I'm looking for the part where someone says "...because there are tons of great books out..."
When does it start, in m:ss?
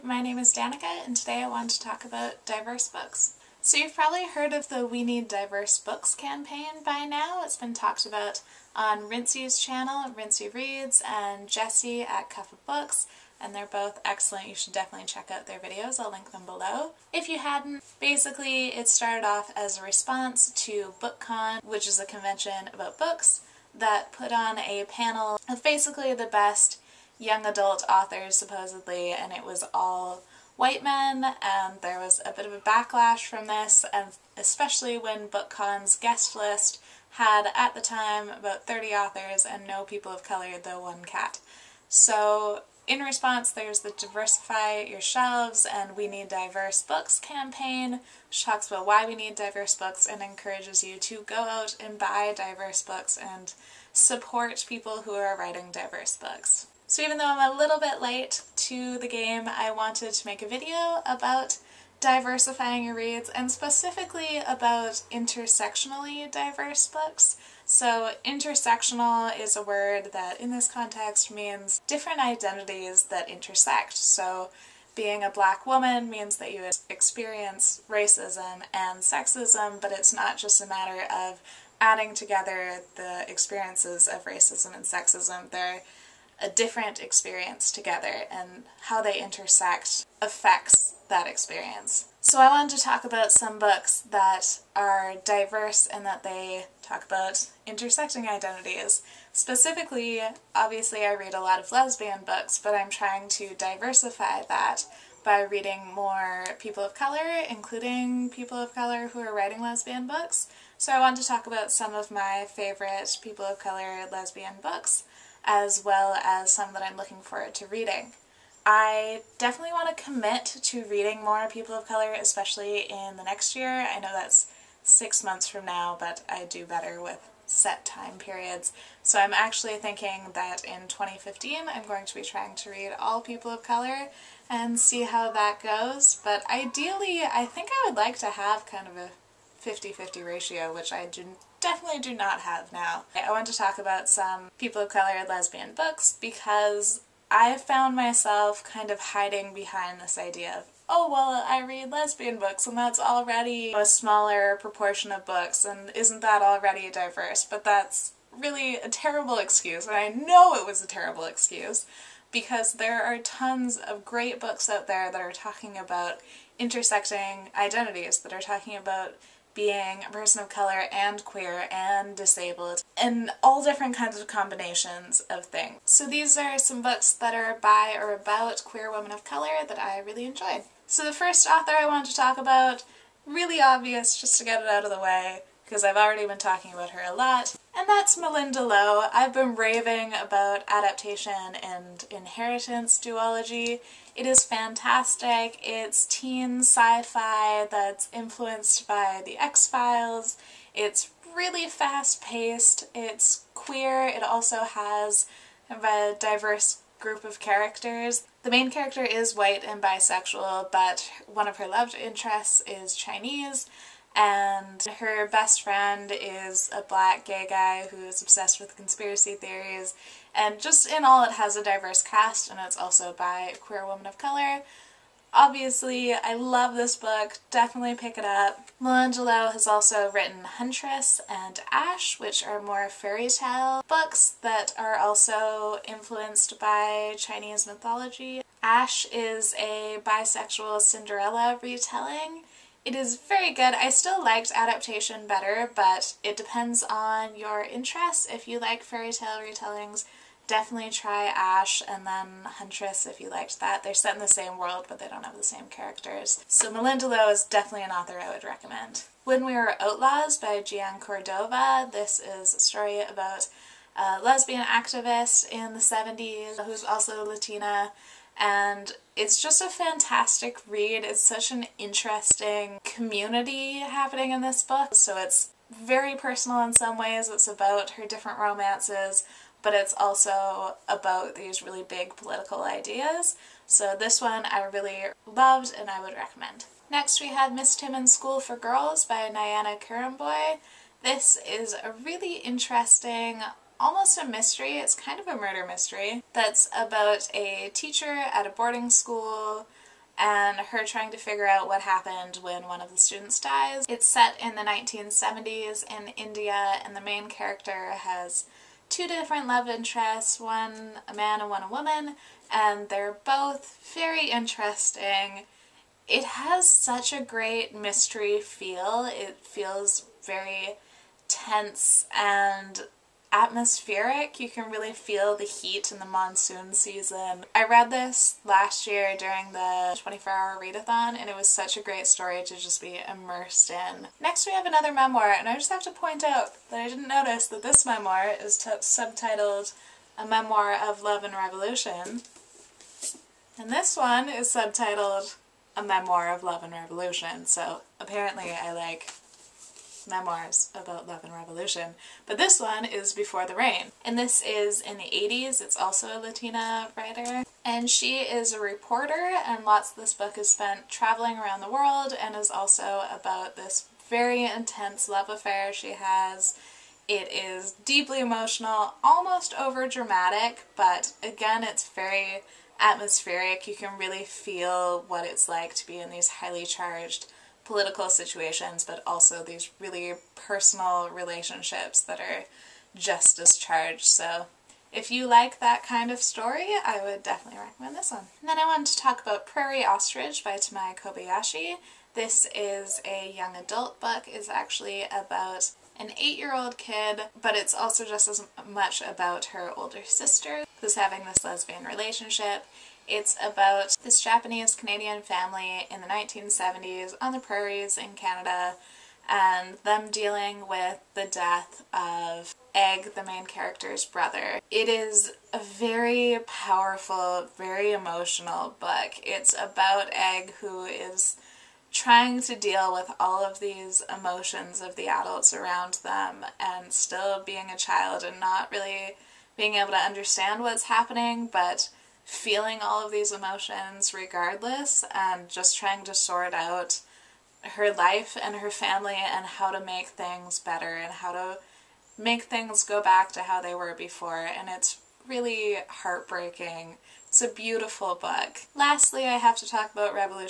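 2:42.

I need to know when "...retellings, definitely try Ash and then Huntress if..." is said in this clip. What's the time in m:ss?
4:09.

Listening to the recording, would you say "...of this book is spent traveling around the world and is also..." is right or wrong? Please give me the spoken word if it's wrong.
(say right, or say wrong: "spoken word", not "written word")
right.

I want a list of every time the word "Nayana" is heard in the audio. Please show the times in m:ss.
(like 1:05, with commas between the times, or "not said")
4:49.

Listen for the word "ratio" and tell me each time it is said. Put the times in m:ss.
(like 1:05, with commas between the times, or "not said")
2:20.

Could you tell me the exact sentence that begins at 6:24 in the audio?
So if you like that kind of story, I would definitely recommend this one.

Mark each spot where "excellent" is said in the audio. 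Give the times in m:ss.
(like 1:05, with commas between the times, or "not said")
0:14.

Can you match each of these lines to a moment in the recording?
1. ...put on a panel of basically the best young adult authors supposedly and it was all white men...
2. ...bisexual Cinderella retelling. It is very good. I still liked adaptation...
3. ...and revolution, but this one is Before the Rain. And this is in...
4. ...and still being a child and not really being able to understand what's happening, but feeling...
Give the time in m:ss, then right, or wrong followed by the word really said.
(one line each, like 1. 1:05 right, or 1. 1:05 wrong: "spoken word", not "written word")
1. 0:24 right
2. 4:00 right
3. 5:51 right
4. 7:06 right.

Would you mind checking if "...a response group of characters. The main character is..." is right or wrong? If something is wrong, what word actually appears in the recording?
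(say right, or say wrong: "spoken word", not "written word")
wrong: "diverse", not "response".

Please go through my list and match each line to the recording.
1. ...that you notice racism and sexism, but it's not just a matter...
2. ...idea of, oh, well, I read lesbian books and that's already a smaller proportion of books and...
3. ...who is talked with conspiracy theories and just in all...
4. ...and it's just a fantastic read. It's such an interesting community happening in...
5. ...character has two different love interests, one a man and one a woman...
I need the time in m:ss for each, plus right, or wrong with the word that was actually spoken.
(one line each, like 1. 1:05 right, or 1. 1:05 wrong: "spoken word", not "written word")
1. 1:16 wrong: "experience", not "notice"
2. 2:30 right
3. 3:37 wrong: "obsessed", not "talked"
4. 4:28 right
5. 5:07 right.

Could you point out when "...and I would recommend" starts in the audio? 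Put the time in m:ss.
4:45.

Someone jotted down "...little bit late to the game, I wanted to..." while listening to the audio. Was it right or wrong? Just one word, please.
right.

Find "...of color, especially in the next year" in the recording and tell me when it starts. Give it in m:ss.
2:01.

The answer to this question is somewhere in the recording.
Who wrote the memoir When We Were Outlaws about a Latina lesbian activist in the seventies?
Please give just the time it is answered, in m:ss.
4:20.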